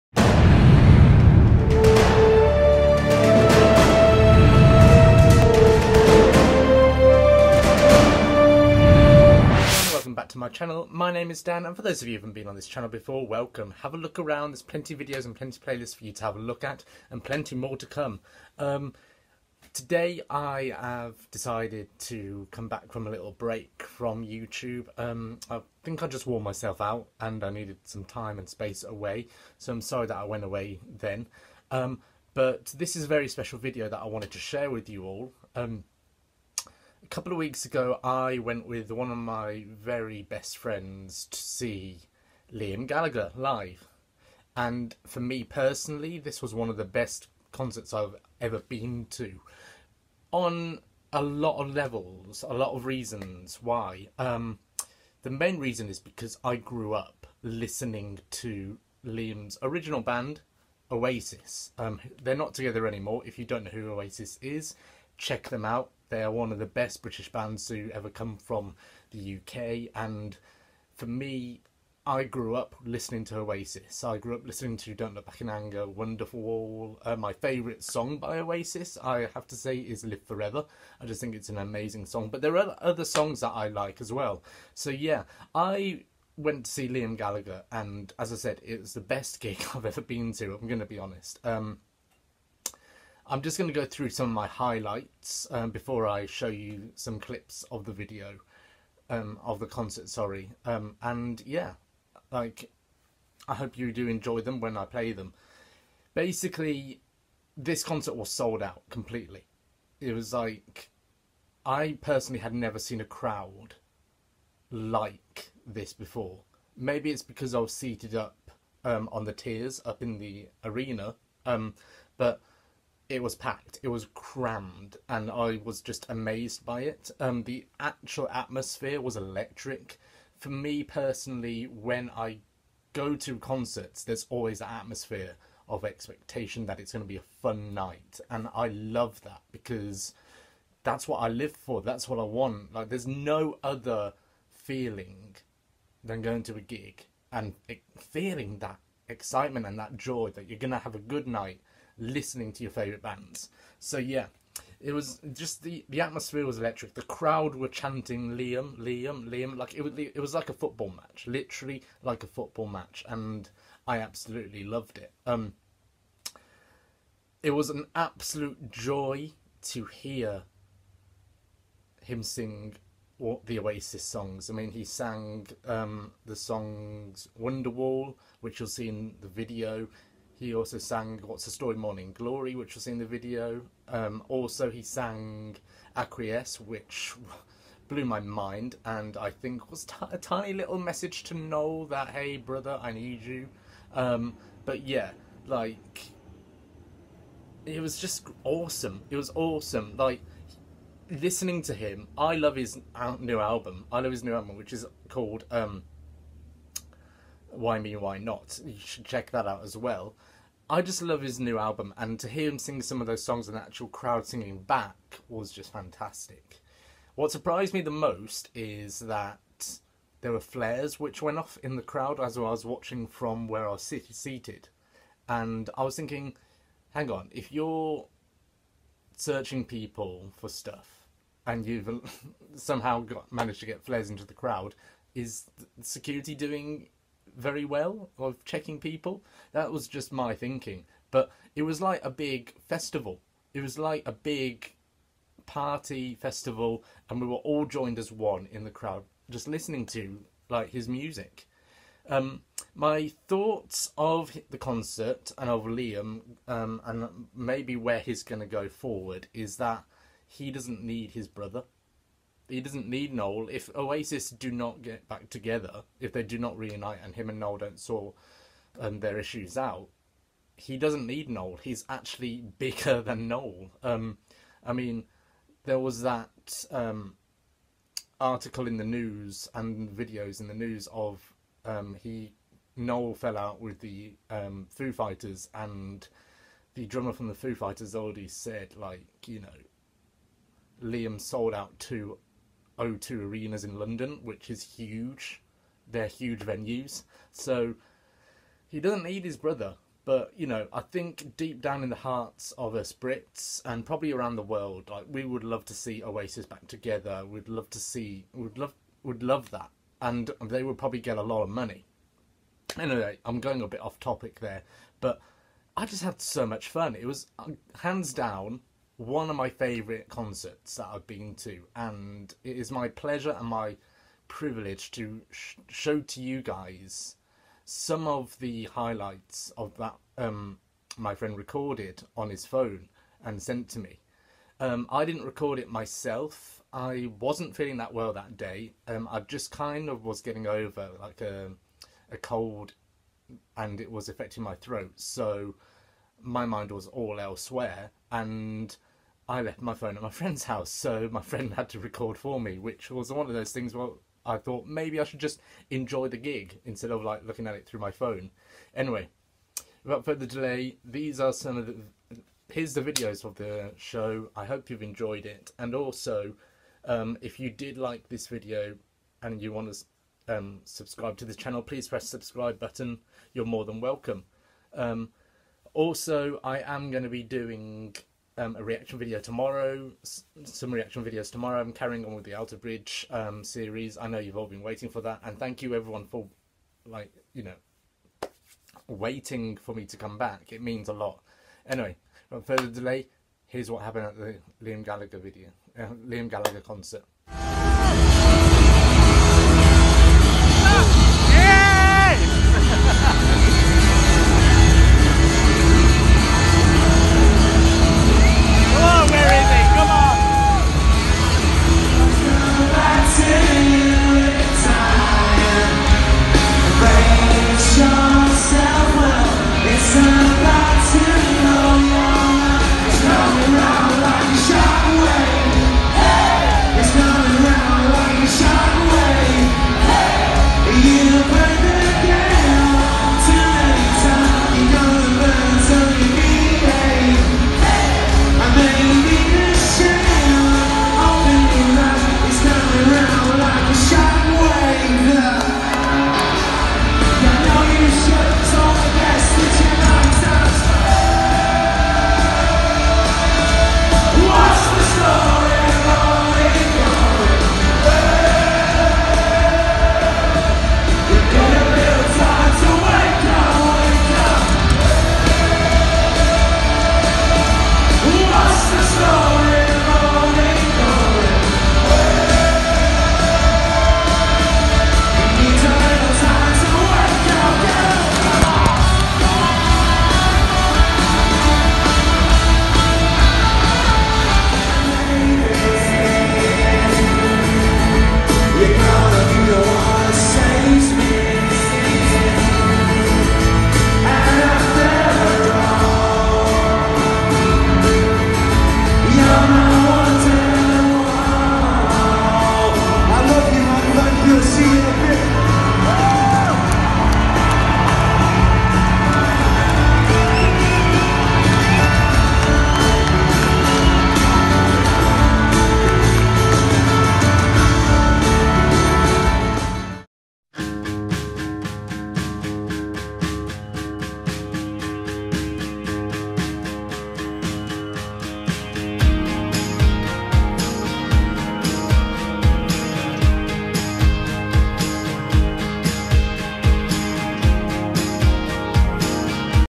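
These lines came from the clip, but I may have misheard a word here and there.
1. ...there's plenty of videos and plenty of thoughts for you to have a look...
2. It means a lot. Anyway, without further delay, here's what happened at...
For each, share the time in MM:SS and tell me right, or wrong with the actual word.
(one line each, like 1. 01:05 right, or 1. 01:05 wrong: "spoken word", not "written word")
1. 00:14 wrong: "playlists", not "thoughts"
2. 06:30 right.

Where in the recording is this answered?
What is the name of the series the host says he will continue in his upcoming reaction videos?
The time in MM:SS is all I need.
06:22.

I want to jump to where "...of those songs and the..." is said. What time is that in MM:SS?
03:33.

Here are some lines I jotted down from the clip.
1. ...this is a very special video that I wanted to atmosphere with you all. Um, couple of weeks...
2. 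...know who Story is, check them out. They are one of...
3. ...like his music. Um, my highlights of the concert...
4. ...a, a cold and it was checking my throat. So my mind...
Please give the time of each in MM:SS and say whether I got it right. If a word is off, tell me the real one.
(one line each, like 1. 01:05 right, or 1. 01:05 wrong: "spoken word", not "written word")
1. 00:32 wrong: "share", not "atmosphere"
2. 01:03 wrong: "Oasis", not "Story"
3. 04:10 wrong: "thoughts", not "highlights"
4. 05:41 wrong: "affecting", not "checking".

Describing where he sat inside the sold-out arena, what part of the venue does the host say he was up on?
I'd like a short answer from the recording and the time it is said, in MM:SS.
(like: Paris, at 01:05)
the tiers, at 01:59.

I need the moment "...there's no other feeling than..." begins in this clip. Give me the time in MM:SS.
02:22.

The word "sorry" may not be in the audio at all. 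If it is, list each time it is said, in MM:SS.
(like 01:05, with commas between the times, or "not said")
00:29, 01:40.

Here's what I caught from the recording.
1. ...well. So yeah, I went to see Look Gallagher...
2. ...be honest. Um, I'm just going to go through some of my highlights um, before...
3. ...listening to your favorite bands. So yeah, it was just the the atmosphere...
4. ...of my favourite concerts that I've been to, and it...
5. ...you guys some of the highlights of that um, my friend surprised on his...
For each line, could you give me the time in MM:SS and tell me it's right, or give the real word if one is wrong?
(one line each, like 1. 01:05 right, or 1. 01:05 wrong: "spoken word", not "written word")
1. 01:24 wrong: "Liam", not "Look"
2. 01:30 right
3. 02:32 right
4. 05:19 right
5. 05:26 wrong: "recorded", not "surprised".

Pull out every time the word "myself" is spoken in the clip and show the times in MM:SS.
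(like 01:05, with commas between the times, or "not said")
00:26, 05:35.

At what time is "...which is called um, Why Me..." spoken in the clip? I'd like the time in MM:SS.
03:24.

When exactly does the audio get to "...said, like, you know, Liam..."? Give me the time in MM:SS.
04:48.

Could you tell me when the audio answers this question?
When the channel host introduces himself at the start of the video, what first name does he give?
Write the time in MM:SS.
00:11.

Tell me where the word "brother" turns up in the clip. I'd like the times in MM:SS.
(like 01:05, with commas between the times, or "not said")
03:12, 04:21, 04:59.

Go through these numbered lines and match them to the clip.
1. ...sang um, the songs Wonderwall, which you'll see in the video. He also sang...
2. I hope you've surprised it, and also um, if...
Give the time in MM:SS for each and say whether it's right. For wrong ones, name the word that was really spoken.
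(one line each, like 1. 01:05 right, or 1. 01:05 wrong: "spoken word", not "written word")
1. 02:54 right
2. 06:04 wrong: "enjoyed", not "surprised".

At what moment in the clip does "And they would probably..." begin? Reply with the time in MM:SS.
05:10.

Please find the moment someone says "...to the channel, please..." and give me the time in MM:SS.
06:11.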